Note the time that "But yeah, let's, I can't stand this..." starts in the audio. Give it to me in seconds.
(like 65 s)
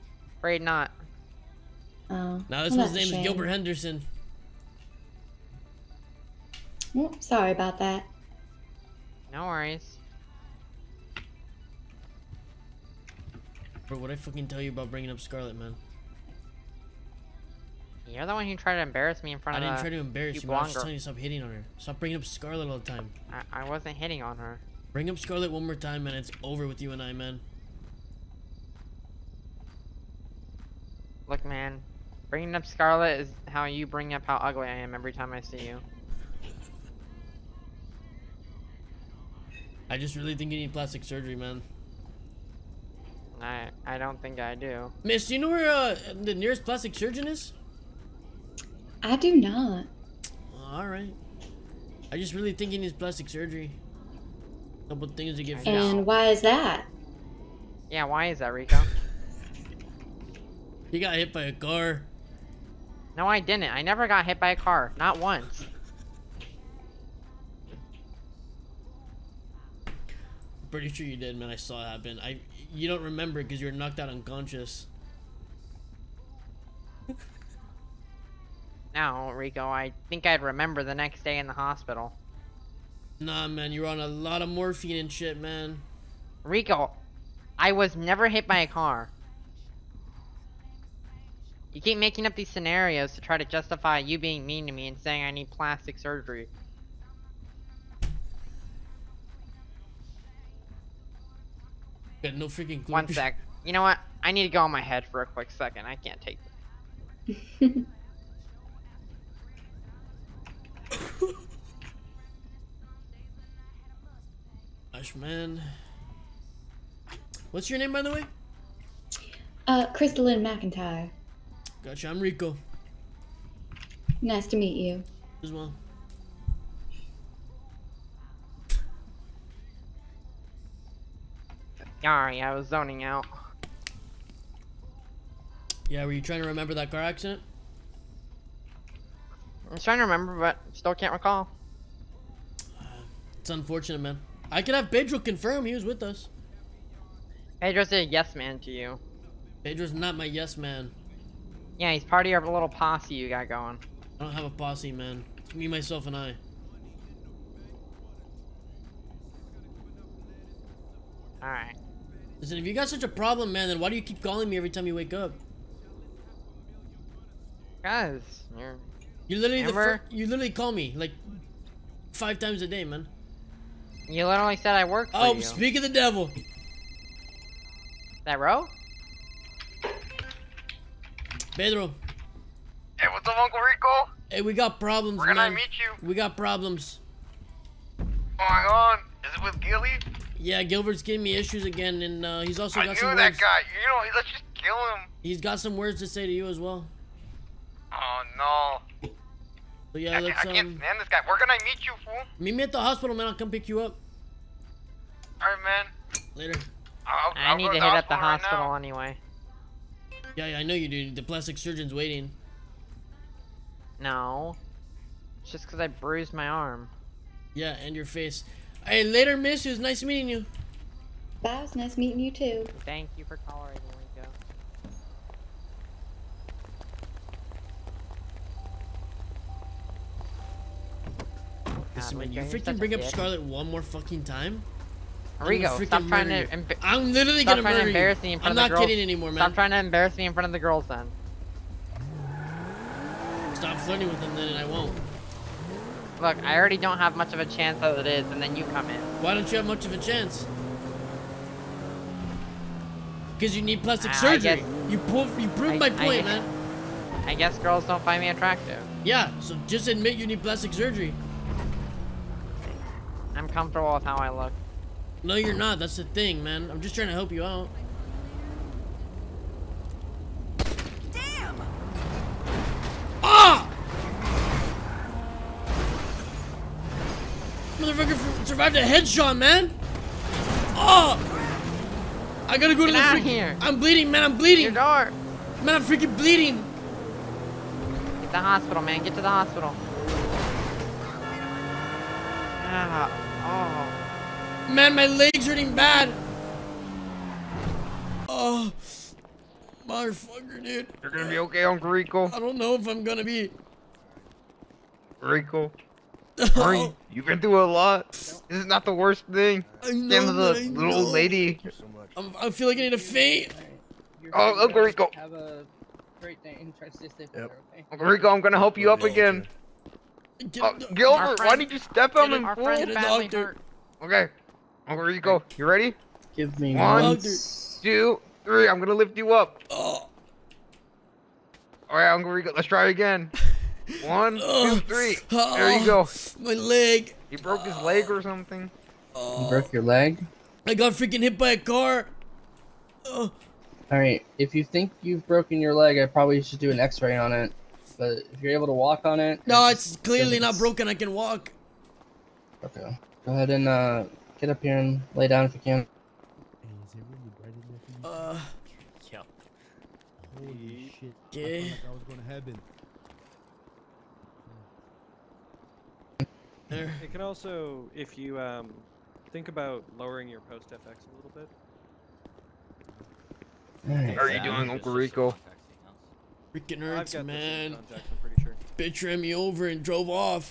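199 s.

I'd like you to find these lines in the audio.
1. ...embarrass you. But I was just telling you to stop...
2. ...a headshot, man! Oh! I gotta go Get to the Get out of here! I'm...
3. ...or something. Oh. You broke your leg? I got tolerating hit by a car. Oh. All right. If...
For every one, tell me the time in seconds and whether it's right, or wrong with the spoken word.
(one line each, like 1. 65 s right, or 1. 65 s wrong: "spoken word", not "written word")
1. 19 s right
2. 278 s right
3. 338 s wrong: "freaking", not "tolerating".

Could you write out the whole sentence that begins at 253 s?
Because you need plastic ah, surgery.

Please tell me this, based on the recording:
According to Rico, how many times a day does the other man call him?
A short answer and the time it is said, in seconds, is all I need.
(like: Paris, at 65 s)
5, at 172 s.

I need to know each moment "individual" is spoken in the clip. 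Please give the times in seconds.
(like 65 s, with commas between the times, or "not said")
not said.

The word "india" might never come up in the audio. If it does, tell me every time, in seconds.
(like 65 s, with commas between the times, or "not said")
not said.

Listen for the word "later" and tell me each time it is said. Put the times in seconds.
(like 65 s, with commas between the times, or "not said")
206 s, 219 s.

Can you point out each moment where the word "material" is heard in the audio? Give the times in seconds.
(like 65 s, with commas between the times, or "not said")
not said.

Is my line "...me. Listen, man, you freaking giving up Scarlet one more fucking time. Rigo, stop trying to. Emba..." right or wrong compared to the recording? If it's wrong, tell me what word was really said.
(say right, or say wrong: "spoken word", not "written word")
wrong: "bring", not "giving".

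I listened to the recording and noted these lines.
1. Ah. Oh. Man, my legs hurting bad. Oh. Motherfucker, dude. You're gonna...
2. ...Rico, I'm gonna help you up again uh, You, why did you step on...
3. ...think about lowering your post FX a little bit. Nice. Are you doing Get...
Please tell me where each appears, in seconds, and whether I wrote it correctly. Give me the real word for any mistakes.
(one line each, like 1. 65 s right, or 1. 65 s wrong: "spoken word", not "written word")
1. 292 s right
2. 318 s wrong: "Gilbert", not "You"
3. 369 s wrong: "Uncle", not "Get".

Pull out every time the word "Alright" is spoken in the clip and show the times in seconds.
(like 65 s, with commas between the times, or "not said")
161 s, 205 s.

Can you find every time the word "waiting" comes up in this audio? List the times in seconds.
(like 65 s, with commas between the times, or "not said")
211 s.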